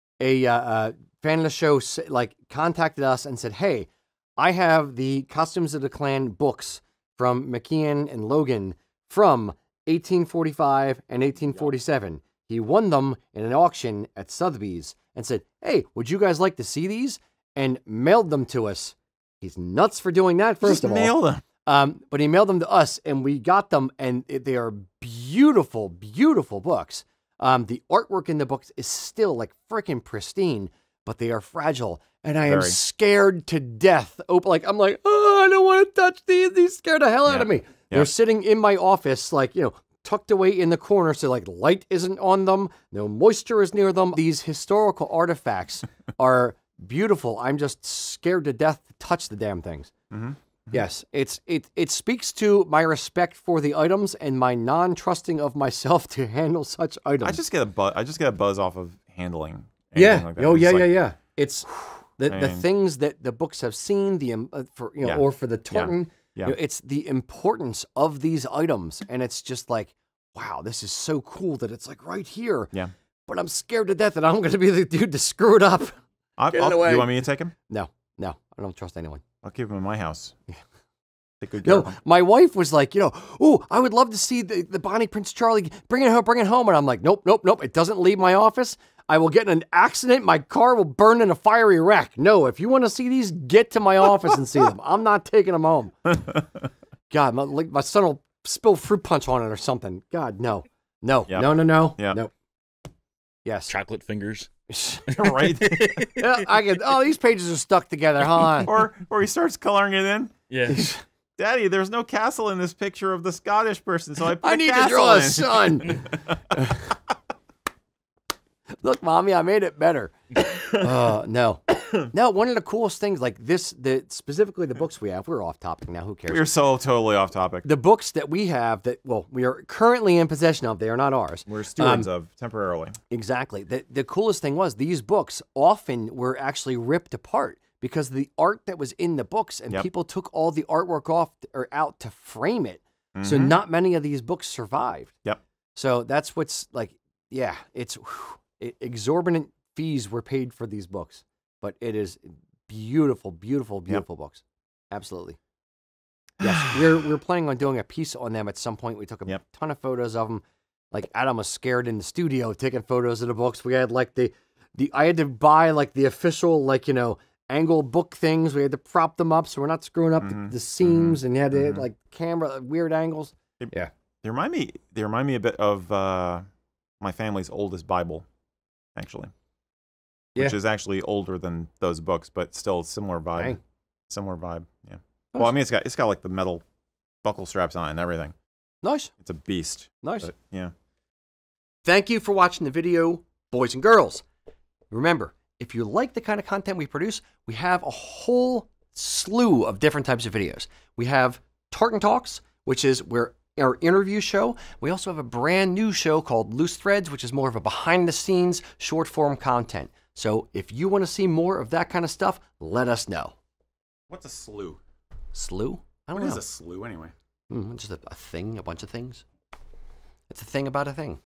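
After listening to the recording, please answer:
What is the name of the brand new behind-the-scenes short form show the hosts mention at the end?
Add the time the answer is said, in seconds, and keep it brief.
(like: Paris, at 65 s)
Loose Threads, at 206 s.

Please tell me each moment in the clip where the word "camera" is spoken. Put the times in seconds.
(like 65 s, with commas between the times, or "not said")
172 s.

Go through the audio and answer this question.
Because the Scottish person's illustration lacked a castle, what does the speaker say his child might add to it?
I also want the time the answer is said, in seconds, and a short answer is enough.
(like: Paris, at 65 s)
A sun, at 115 s.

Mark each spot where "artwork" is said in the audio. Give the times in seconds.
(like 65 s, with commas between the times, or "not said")
27 s, 140 s.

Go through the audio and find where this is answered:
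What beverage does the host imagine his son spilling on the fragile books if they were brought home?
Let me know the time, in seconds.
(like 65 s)
98 s.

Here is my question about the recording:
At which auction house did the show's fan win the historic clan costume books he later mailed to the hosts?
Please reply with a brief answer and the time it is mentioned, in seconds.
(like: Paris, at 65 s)
Sotheby's, at 14 s.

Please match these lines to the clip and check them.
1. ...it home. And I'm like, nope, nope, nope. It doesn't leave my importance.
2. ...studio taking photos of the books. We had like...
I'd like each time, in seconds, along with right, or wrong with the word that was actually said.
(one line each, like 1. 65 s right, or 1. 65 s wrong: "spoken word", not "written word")
1. 86 s wrong: "office", not "importance"
2. 162 s right.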